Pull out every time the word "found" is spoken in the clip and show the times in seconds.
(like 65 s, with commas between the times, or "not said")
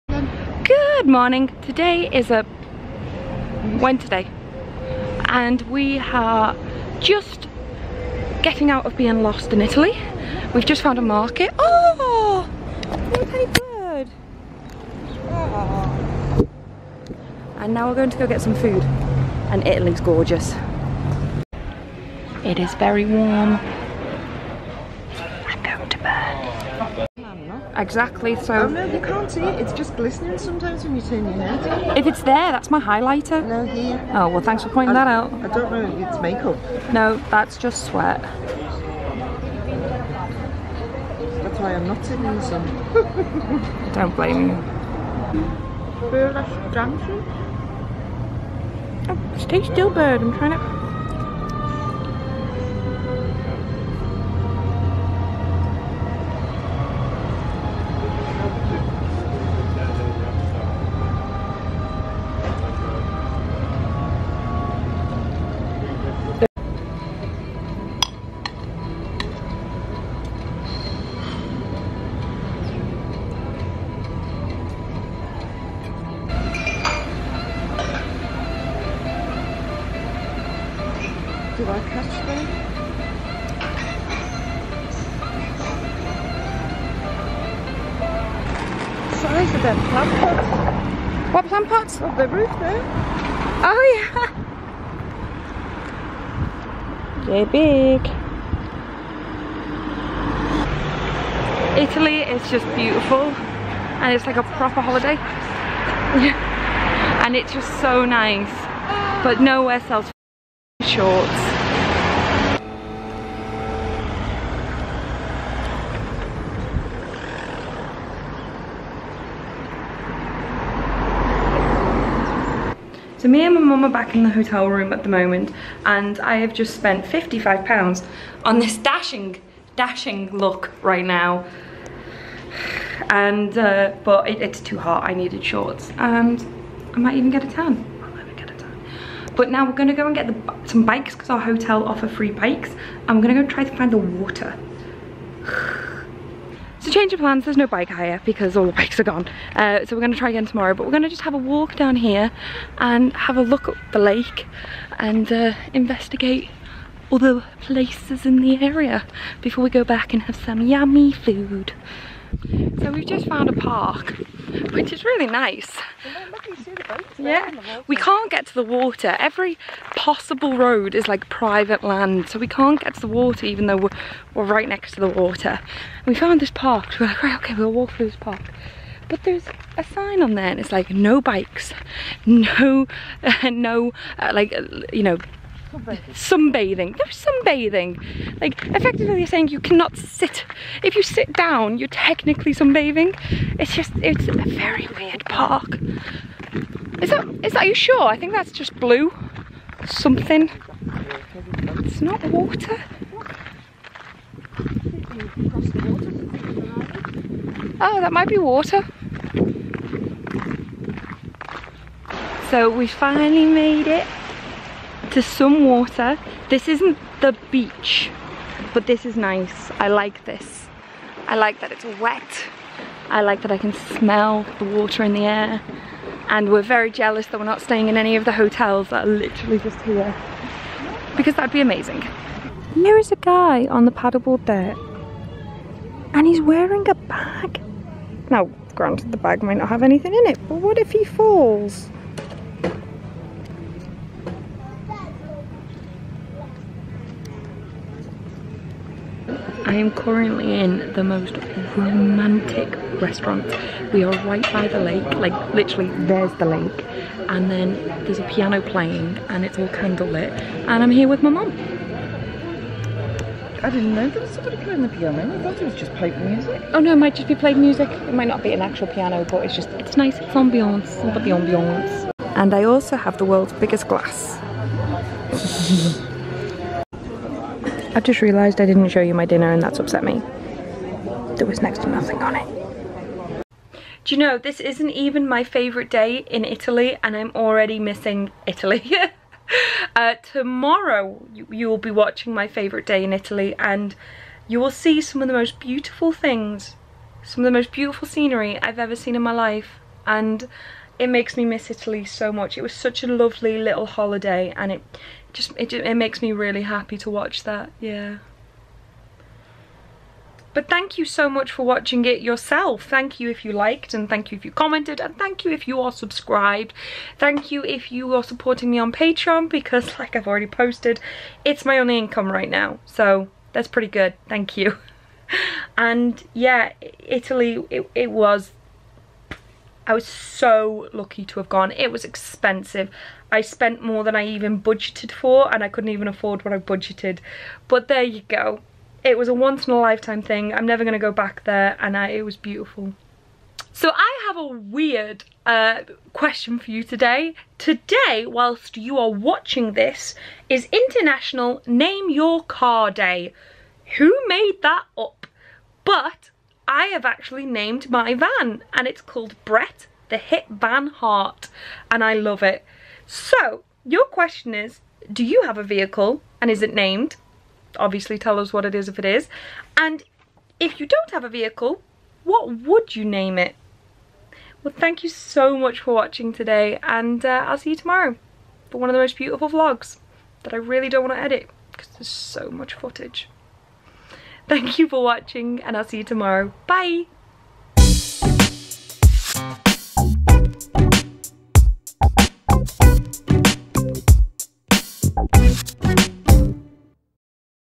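10 s, 163 s, 176 s.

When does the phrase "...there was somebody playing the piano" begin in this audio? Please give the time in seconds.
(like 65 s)
264 s.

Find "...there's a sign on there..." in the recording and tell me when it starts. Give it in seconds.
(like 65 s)
179 s.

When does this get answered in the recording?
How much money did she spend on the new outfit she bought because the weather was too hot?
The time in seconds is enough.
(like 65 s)
127 s.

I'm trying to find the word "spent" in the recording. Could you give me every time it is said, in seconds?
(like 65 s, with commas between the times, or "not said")
126 s, 333 s.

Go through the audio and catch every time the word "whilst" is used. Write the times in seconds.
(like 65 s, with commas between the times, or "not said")
348 s.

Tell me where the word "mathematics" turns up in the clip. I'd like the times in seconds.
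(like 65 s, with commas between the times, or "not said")
not said.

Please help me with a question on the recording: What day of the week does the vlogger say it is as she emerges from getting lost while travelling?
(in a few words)
Wednesday.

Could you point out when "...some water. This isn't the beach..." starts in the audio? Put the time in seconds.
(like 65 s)
215 s.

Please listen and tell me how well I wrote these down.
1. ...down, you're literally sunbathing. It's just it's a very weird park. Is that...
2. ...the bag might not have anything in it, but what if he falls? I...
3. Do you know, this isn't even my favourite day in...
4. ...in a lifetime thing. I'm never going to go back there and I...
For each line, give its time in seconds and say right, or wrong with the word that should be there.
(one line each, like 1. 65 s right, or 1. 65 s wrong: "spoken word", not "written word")
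1. 191 s wrong: "technically", not "literally"
2. 239 s right
3. 284 s right
4. 339 s right.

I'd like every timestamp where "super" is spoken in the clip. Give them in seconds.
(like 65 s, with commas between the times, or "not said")
not said.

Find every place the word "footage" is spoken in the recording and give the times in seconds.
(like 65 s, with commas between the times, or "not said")
382 s.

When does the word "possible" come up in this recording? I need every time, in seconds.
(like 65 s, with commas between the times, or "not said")
169 s.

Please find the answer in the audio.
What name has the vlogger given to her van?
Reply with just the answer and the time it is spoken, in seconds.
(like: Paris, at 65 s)
Brett the Hit Van Heart, at 359 s.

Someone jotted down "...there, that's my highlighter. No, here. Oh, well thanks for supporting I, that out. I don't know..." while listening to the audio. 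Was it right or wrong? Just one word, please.
wrong.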